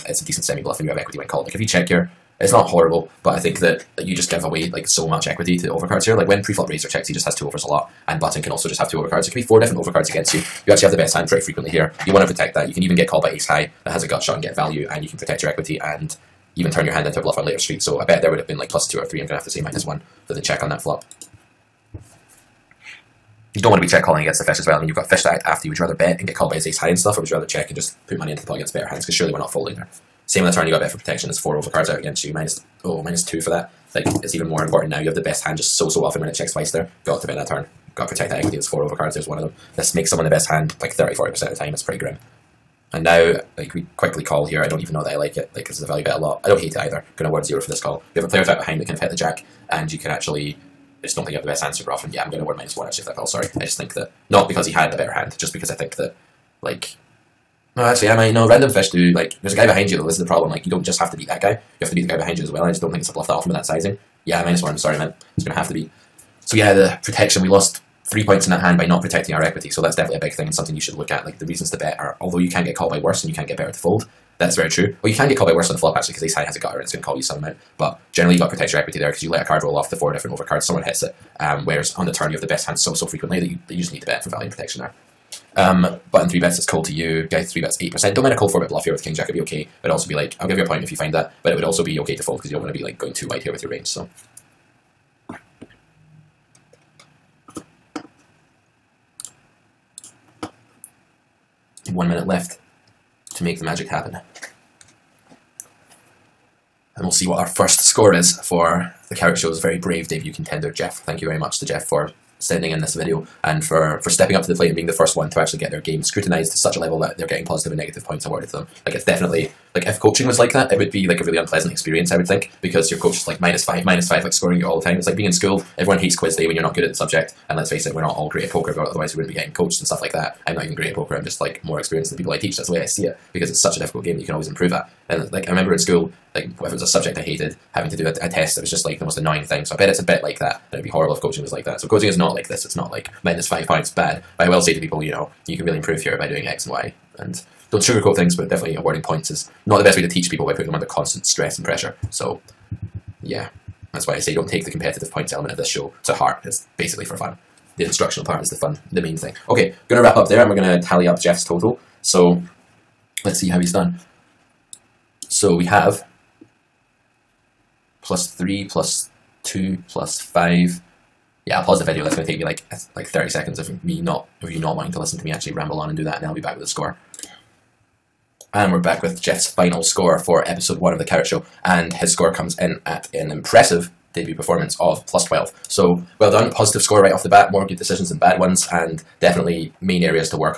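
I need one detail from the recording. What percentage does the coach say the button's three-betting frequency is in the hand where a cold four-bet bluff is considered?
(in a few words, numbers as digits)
8%.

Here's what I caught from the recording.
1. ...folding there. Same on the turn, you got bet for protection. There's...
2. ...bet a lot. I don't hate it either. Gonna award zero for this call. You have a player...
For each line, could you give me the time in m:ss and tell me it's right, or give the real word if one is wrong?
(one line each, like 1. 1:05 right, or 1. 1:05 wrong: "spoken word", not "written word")
1. 0:29 right
2. 0:46 right.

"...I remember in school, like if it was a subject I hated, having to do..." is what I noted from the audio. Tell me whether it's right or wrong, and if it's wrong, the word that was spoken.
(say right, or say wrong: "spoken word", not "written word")
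right.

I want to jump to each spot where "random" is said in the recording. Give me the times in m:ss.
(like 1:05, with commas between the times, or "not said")
0:58.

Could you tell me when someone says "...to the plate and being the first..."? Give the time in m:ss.
1:54.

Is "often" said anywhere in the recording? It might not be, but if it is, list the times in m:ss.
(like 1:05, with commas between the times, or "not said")
0:36, 0:51, 1:03.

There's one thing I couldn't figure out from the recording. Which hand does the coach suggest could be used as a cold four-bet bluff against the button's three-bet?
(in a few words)
King Jack.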